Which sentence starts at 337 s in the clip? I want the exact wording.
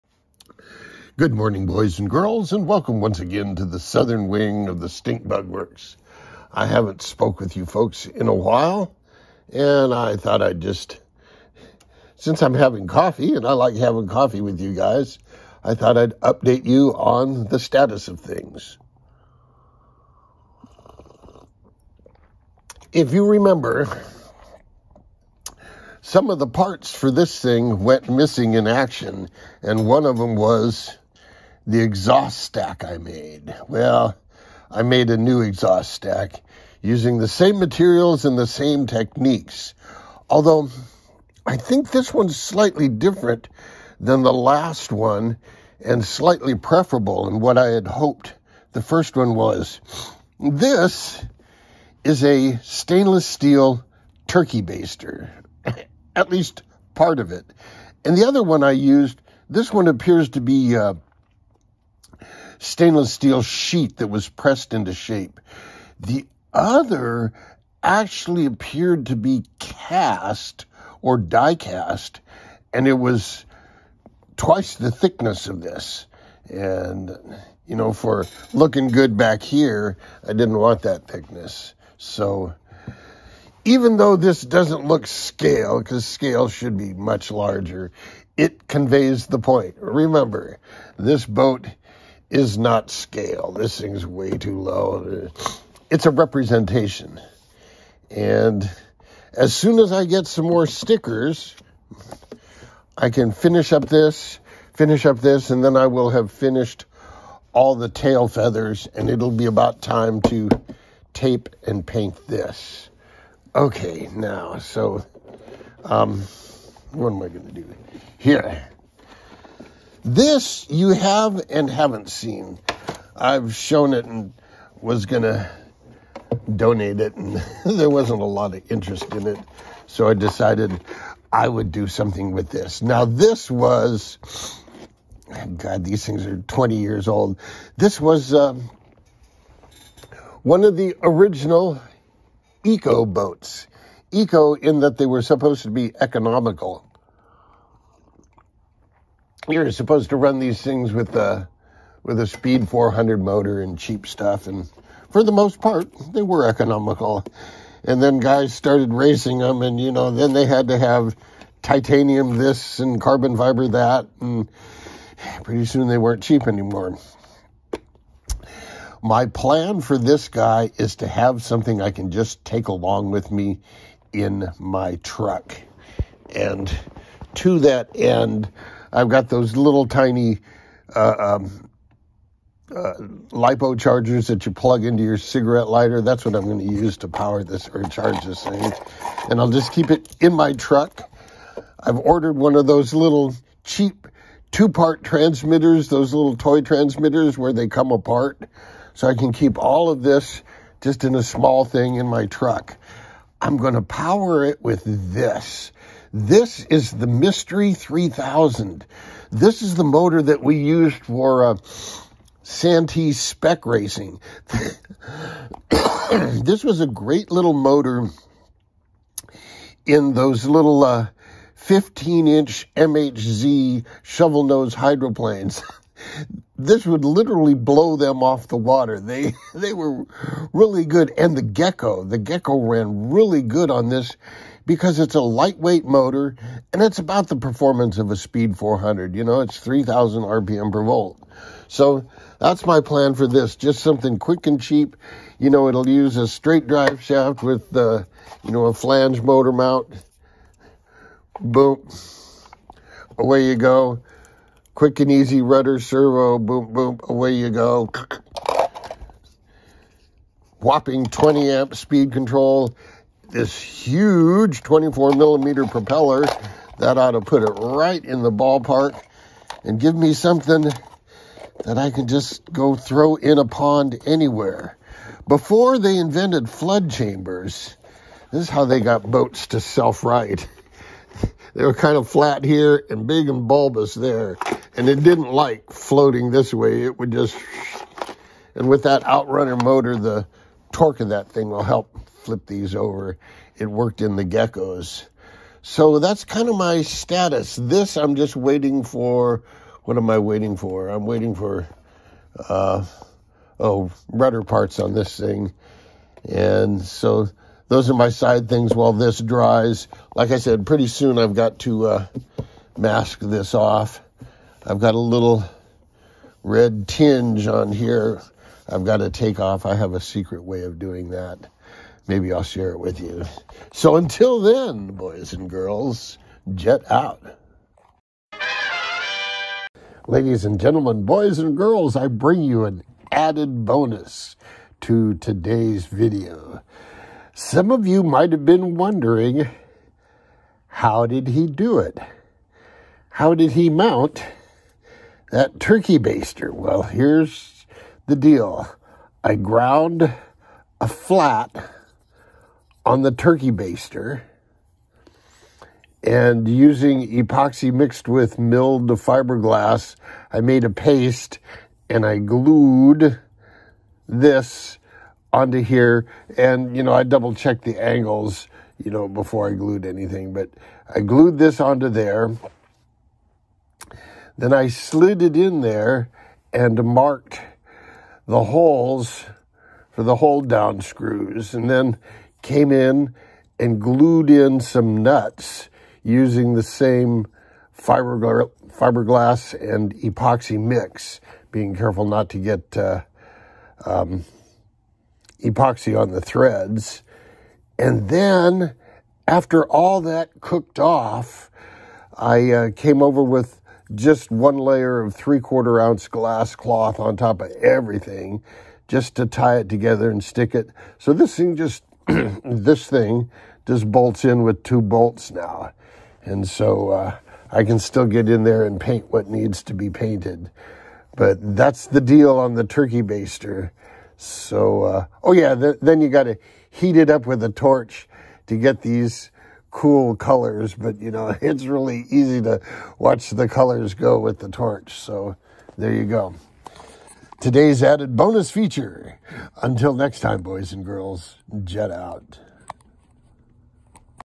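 Some of you might have been wondering, how did he do it?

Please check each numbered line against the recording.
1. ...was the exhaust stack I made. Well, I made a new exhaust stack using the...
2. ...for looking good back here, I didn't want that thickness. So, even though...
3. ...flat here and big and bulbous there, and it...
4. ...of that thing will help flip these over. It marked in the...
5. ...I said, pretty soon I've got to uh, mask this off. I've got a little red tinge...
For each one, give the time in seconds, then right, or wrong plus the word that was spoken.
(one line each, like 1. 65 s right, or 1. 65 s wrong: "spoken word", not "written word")
1. 30 s right
2. 77 s right
3. 282 s right
4. 291 s wrong: "worked", not "marked"
5. 310 s right.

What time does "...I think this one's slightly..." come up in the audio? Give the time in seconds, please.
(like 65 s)
41 s.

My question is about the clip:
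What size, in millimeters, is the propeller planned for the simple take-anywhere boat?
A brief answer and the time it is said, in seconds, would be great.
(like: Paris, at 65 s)
24 millimeter, at 264 s.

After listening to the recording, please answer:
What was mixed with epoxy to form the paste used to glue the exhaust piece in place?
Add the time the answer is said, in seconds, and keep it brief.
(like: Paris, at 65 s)
milled fiberglass, at 358 s.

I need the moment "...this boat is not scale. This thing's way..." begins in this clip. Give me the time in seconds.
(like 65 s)
90 s.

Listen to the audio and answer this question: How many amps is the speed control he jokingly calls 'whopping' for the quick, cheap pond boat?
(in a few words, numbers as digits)
20.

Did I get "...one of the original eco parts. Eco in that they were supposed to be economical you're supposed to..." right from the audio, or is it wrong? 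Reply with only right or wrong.
wrong.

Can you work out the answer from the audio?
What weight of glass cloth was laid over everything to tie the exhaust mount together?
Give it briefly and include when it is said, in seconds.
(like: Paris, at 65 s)
3/4 ounce, at 405 s.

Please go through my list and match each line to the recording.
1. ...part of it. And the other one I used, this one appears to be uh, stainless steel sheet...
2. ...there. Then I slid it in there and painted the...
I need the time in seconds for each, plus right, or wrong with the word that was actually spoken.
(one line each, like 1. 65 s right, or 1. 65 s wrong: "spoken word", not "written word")
1. 56 s right
2. 371 s wrong: "marked", not "painted".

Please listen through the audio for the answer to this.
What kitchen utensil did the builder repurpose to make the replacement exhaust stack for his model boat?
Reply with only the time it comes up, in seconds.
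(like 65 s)
52 s.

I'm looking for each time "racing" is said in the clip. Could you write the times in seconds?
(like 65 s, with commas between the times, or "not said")
158 s, 213 s.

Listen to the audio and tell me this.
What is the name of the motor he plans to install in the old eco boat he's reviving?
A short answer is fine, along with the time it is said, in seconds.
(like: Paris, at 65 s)
Mystery 3000, at 207 s.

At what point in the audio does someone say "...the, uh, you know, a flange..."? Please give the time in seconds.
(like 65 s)
247 s.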